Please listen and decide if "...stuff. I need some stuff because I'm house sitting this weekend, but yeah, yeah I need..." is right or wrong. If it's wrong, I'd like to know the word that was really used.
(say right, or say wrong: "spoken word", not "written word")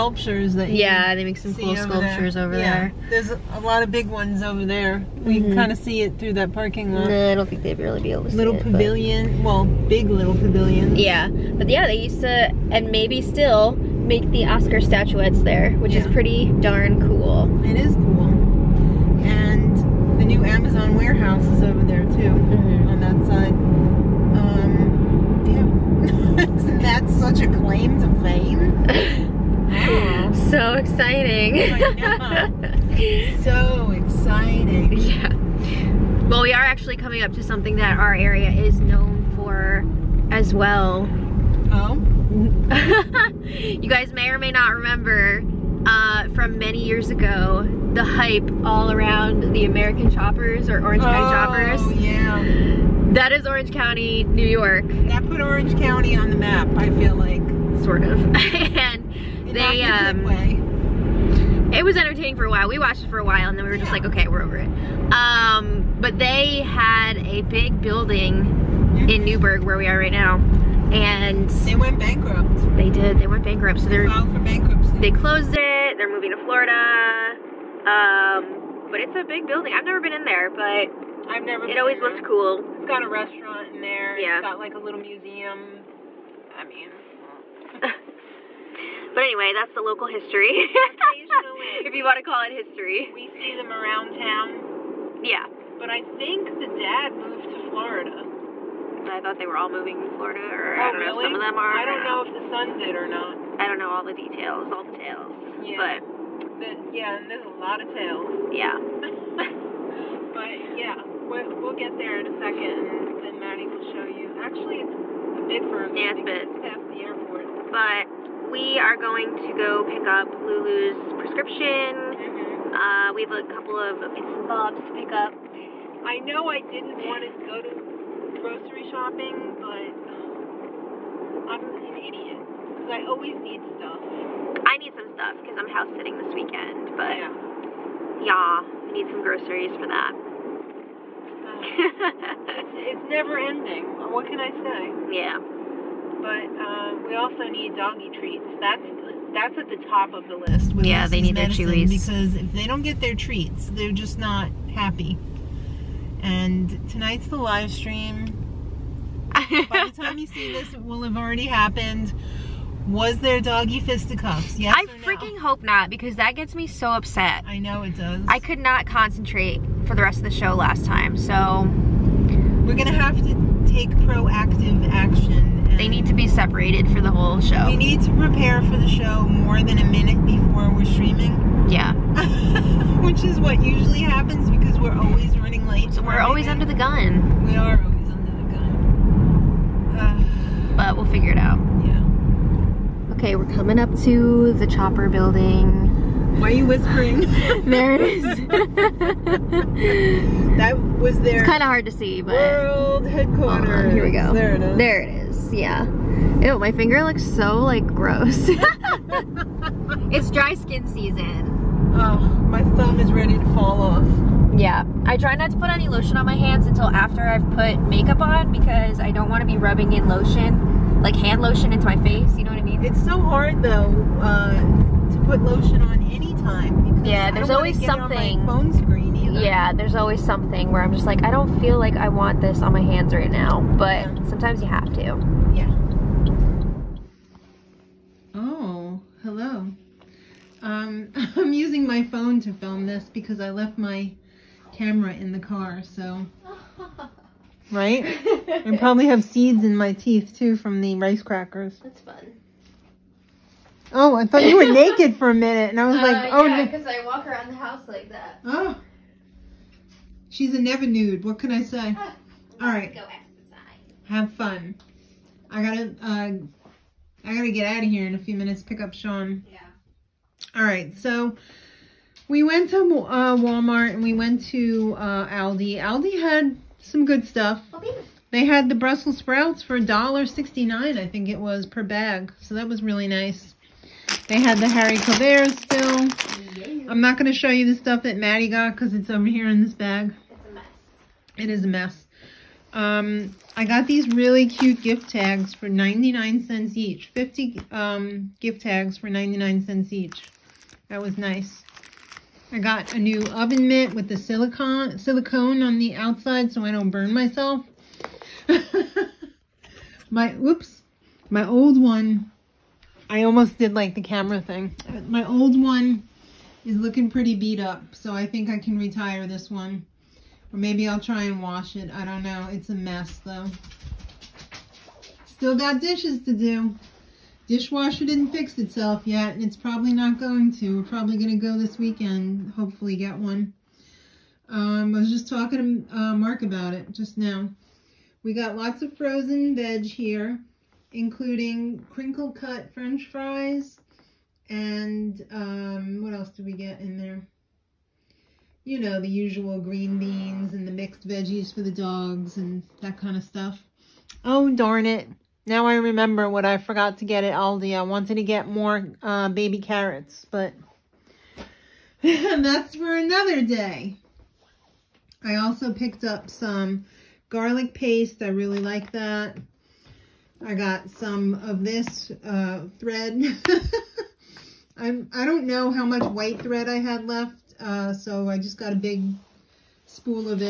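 right.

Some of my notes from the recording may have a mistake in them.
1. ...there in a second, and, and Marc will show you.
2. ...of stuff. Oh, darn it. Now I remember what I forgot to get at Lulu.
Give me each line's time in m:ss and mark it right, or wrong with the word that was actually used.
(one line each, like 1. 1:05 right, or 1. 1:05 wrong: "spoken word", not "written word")
1. 1:51 wrong: "Maddie", not "Marc"
2. 5:53 wrong: "Aldi", not "Lulu".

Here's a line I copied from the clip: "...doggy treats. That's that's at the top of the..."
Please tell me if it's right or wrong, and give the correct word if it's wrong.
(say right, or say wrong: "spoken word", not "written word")
right.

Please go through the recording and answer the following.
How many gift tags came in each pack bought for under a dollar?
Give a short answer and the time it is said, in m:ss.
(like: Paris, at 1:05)
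50, at 4:57.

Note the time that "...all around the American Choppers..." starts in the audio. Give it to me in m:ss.
0:48.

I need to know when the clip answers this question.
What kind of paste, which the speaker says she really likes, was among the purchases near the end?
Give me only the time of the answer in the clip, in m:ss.
6:07.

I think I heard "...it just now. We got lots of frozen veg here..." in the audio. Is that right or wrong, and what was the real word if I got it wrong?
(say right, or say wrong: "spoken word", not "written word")
right.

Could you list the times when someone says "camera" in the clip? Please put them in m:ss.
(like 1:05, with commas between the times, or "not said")
4:04, 5:14.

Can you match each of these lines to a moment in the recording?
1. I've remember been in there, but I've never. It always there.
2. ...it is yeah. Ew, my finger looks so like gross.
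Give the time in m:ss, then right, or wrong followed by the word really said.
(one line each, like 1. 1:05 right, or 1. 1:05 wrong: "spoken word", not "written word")
1. 1:19 wrong: "never", not "remember"
2. 3:25 right.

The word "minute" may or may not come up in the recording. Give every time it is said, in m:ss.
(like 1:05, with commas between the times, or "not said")
2:59, 4:15, 4:28.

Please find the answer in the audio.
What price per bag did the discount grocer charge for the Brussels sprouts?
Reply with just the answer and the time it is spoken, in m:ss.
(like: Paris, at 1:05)
$1.69, at 4:39.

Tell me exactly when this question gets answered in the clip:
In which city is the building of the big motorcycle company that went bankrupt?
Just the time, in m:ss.
1:09.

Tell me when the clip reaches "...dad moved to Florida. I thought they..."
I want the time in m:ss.
1:36.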